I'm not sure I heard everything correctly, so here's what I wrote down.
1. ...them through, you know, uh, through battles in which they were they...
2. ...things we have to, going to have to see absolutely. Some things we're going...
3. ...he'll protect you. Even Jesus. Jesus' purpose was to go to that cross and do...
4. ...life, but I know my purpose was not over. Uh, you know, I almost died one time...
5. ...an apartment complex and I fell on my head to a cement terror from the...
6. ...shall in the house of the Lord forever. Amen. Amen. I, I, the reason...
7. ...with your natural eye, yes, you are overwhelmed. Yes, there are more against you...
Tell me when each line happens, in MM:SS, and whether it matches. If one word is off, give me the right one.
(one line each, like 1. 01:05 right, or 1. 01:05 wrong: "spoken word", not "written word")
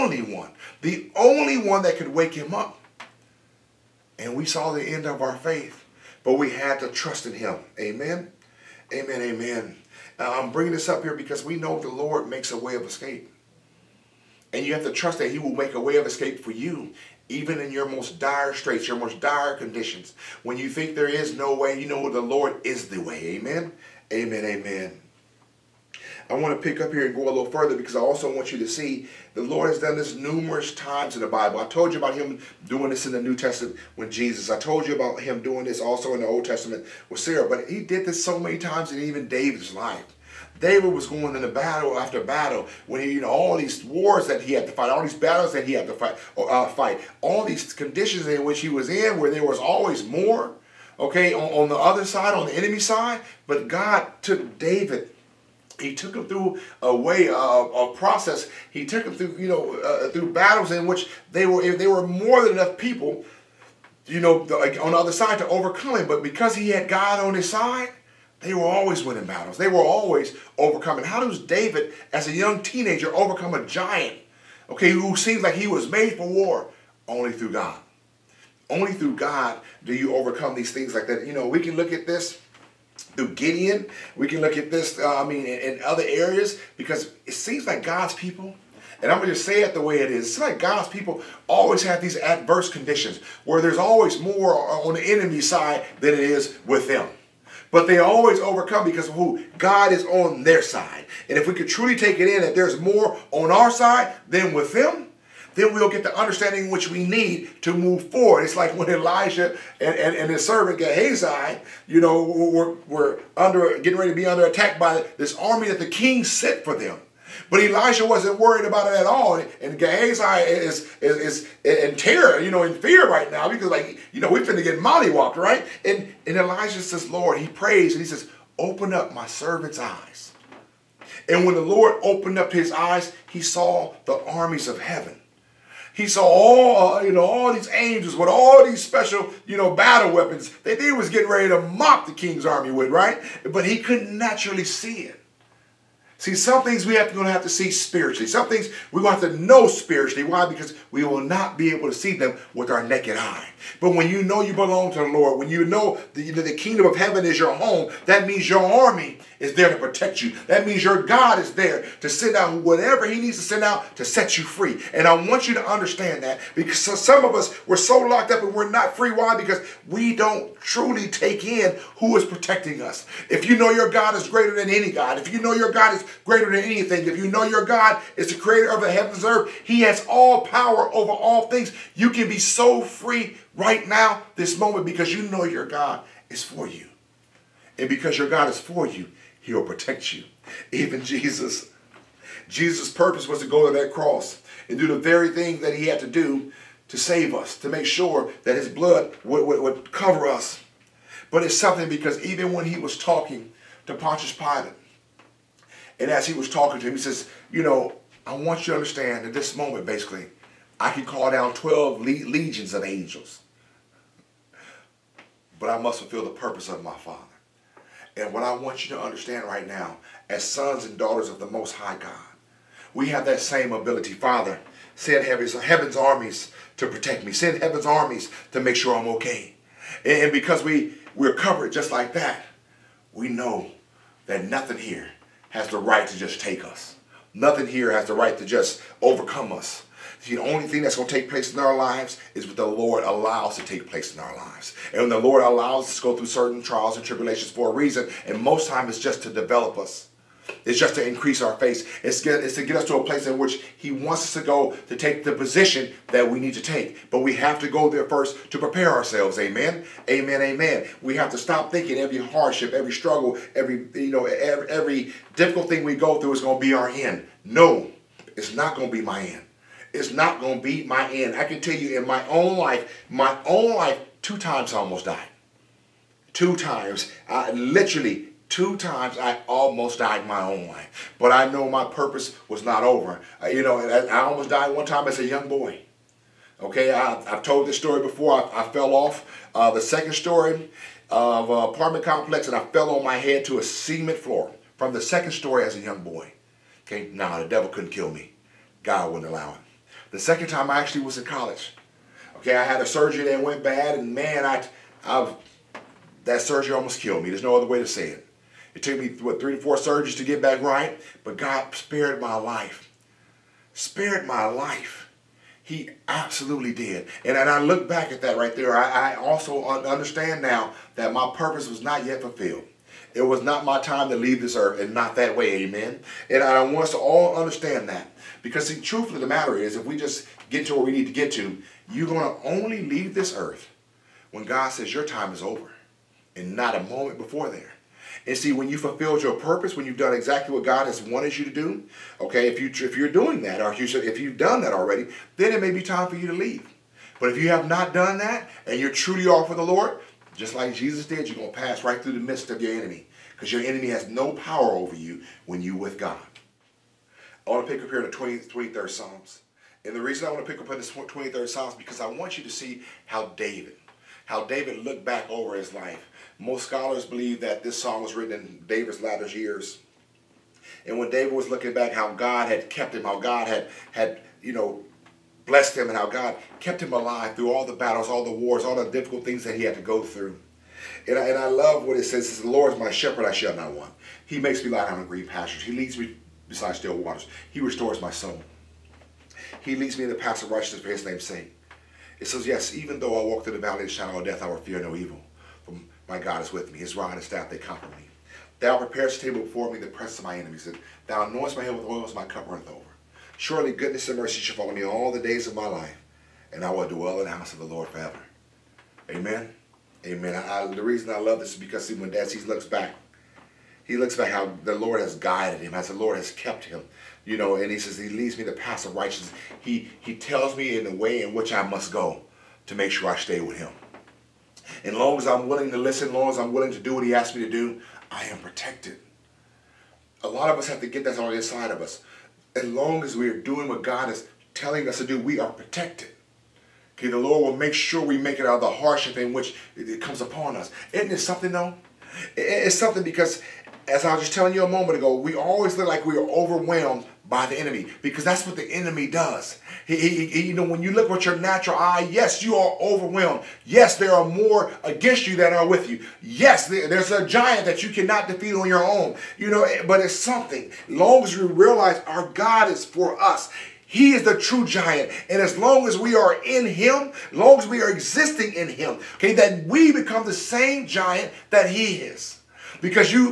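1. 00:59 right
2. 02:26 wrong: "spiritually", not "absolutely"
3. 03:09 right
4. 04:40 right
5. 04:51 wrong: "floor", not "terror"
6. 06:46 wrong: "dwell", not "shall"
7. 07:31 right.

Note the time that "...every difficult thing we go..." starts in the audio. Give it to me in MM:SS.
04:24.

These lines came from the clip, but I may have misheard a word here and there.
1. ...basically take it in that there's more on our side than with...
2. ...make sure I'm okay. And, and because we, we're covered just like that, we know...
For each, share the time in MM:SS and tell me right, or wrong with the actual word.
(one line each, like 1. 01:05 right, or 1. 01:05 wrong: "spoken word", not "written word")
1. 01:41 wrong: "truly", not "basically"
2. 03:48 right.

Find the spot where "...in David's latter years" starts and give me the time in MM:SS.
06:08.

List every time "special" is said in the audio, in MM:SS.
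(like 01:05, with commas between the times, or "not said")
02:18.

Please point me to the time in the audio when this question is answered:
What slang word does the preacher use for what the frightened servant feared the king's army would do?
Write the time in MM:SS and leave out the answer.
02:04.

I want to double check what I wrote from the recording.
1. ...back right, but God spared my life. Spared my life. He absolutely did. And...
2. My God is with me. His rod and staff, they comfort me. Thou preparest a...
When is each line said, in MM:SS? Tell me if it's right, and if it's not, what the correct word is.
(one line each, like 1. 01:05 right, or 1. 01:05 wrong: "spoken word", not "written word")
1. 05:10 right
2. 06:36 right.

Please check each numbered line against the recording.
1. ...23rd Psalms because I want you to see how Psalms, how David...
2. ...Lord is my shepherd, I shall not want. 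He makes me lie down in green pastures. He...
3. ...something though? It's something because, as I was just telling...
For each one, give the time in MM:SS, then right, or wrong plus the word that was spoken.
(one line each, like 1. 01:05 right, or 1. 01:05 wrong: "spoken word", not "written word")
1. 06:00 wrong: "David", not "Psalms"
2. 06:22 right
3. 07:21 right.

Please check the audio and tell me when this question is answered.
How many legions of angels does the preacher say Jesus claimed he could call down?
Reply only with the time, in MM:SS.
03:31.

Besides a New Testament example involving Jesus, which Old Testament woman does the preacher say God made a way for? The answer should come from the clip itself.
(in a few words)
Sarah.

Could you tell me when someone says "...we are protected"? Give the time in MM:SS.
07:15.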